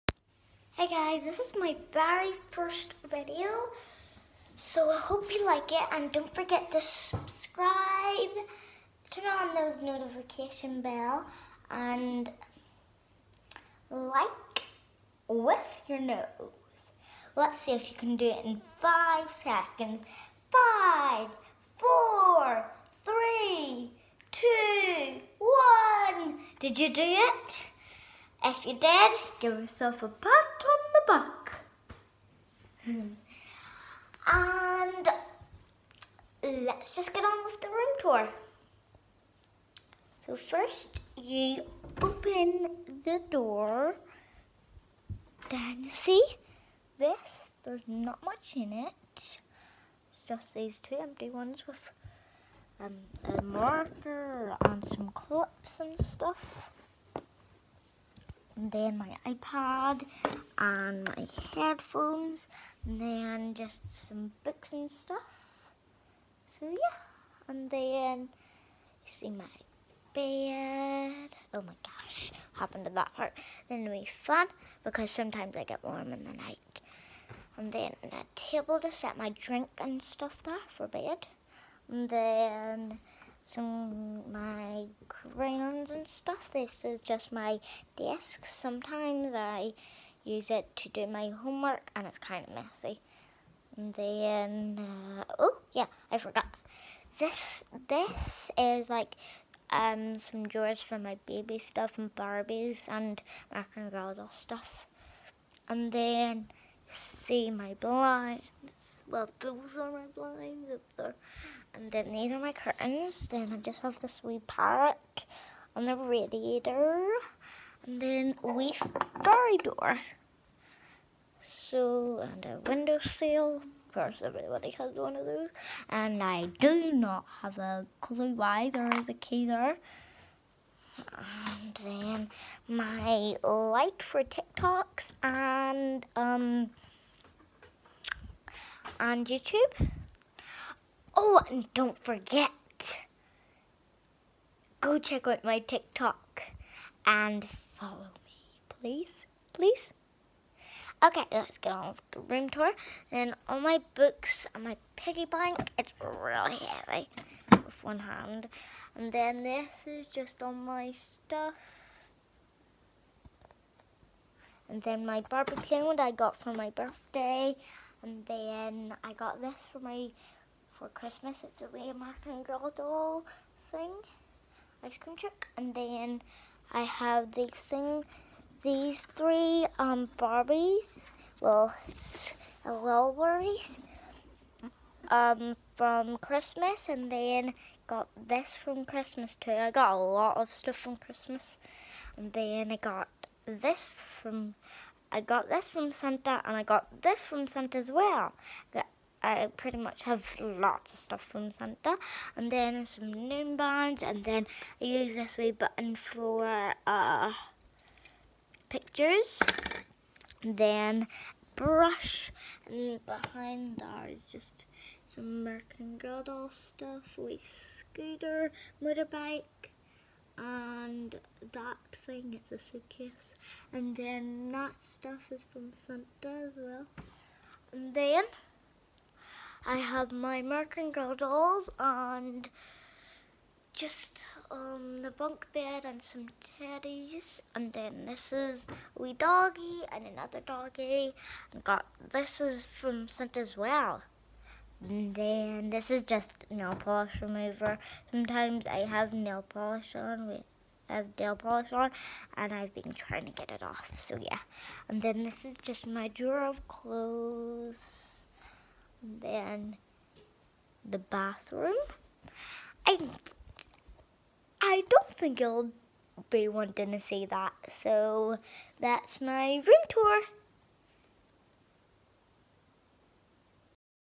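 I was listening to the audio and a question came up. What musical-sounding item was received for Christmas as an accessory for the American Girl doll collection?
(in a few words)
Ice cream truck.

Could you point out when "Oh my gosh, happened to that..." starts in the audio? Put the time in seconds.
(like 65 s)
71 s.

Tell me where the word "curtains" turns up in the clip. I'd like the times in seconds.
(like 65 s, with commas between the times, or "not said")
112 s.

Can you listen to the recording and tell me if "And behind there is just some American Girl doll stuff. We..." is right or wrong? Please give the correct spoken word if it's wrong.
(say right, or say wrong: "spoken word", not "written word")
right.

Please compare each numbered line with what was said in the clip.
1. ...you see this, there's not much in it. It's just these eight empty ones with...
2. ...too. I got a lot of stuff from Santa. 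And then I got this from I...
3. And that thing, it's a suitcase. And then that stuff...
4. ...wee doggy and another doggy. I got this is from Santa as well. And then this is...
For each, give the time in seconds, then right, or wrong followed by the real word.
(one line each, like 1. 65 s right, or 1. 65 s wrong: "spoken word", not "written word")
1. 45 s wrong: "two", not "eight"
2. 189 s wrong: "Christmas", not "Santa"
3. 220 s right
4. 238 s right.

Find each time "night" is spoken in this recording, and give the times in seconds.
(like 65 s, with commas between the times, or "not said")
76 s.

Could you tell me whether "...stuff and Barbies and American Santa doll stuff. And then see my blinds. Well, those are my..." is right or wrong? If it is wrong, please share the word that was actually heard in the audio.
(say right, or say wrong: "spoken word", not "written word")
wrong: "Girl", not "Santa".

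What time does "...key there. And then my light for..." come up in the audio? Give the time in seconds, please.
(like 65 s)
129 s.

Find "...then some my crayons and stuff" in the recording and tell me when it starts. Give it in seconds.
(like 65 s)
82 s.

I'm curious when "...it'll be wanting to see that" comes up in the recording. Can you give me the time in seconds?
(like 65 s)
265 s.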